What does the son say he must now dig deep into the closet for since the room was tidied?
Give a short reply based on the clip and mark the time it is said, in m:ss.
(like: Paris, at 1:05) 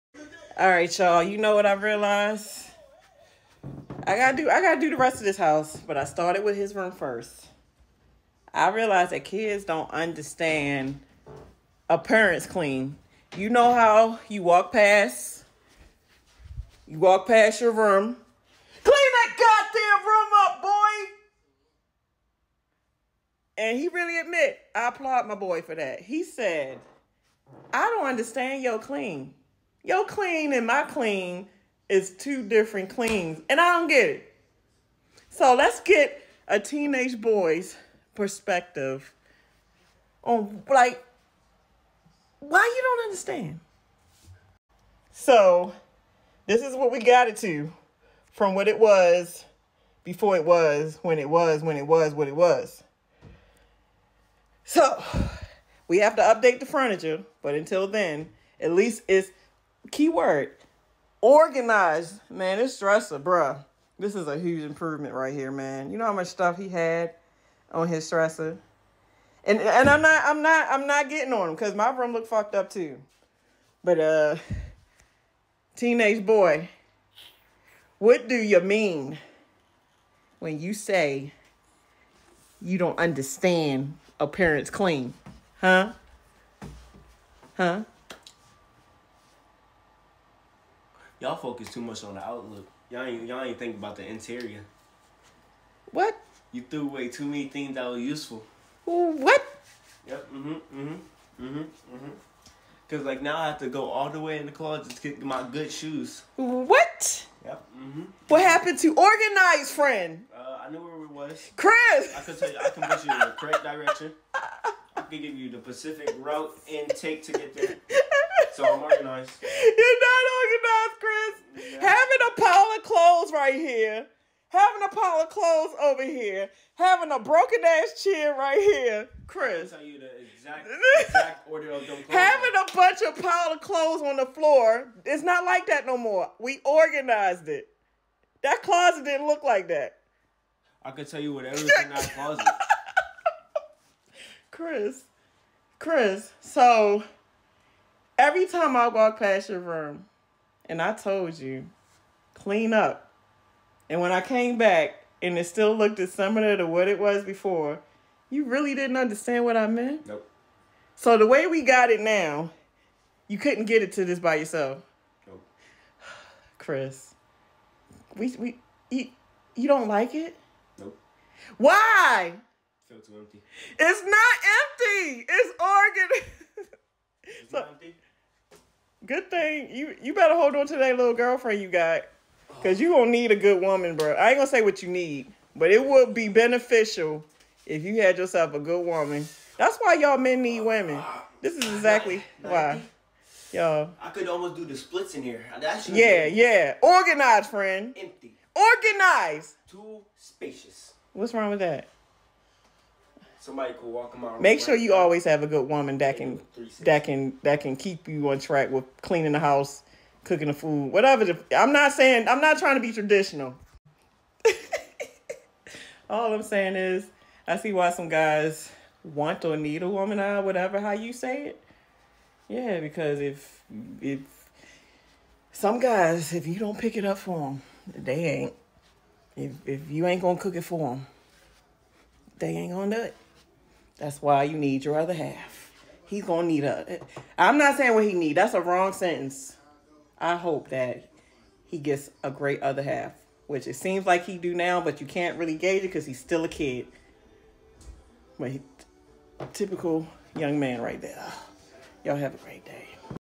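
good shoes, at 1:45.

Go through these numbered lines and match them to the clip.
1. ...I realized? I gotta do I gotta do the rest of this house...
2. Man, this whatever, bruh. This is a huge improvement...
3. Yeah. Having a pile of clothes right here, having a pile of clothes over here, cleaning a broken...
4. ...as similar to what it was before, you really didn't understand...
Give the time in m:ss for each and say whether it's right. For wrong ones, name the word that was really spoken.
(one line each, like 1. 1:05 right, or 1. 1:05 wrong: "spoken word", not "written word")
1. 0:01 right
2. 1:02 wrong: "dresser", not "whatever"
3. 2:01 wrong: "having", not "cleaning"
4. 2:35 right.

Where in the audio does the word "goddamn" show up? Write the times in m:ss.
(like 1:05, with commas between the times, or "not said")
0:20.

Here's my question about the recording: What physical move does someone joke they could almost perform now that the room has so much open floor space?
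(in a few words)
the splits.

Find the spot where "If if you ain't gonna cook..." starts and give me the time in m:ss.
3:49.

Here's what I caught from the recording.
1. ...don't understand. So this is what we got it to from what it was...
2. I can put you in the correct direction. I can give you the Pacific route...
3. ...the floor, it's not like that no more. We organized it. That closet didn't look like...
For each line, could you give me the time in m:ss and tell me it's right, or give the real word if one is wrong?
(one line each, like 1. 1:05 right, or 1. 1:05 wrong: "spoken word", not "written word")
1. 0:42 right
2. 1:52 right
3. 2:14 right.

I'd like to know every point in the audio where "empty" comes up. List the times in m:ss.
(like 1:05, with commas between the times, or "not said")
2:53, 3:17.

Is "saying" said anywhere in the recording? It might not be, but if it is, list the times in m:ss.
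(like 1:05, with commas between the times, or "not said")
3:31, 3:36, 3:57.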